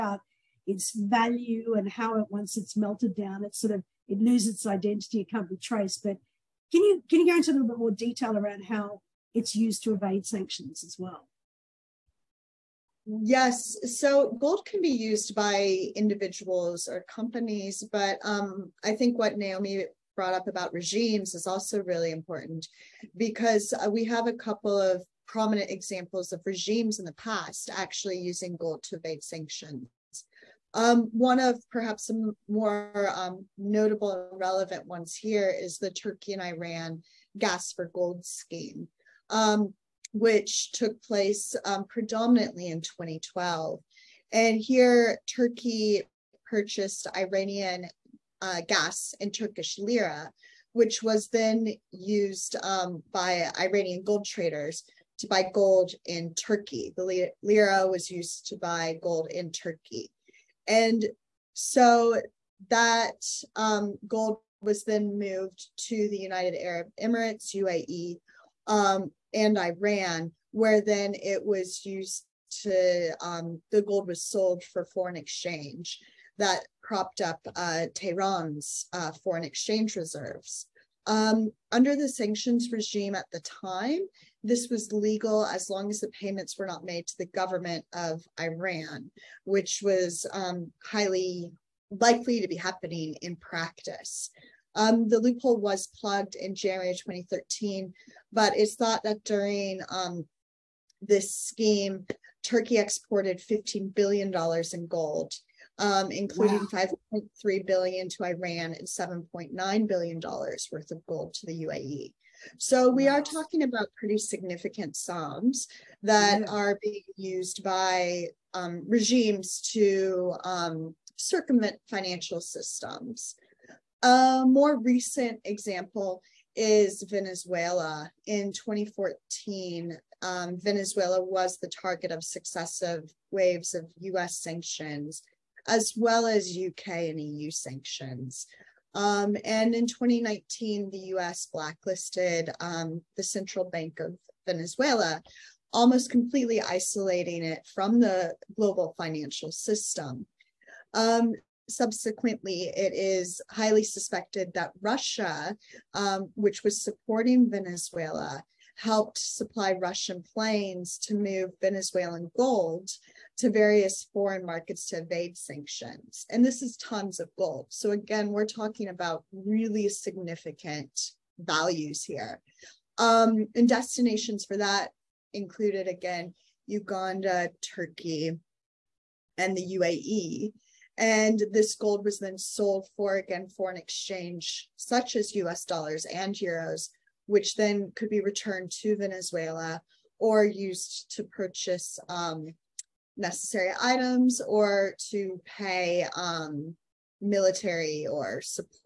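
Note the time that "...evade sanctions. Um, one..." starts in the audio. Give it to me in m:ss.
0:28.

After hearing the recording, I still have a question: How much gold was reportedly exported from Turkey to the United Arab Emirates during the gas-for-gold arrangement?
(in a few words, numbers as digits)
$7.9 billion.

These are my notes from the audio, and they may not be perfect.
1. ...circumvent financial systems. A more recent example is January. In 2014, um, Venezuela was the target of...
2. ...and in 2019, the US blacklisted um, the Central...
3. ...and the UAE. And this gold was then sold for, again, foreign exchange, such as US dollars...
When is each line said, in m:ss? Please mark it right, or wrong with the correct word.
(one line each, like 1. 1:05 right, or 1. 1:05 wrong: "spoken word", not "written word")
1. 2:01 wrong: "Venezuela", not "January"
2. 2:19 right
3. 2:59 right.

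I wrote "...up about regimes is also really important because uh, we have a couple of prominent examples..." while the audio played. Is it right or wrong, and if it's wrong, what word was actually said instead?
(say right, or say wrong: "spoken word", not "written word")
right.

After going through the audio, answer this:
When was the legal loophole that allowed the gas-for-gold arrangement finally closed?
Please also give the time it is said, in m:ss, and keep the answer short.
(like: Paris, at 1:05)
January 2013, at 1:36.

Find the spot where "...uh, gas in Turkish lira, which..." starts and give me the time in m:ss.
0:48.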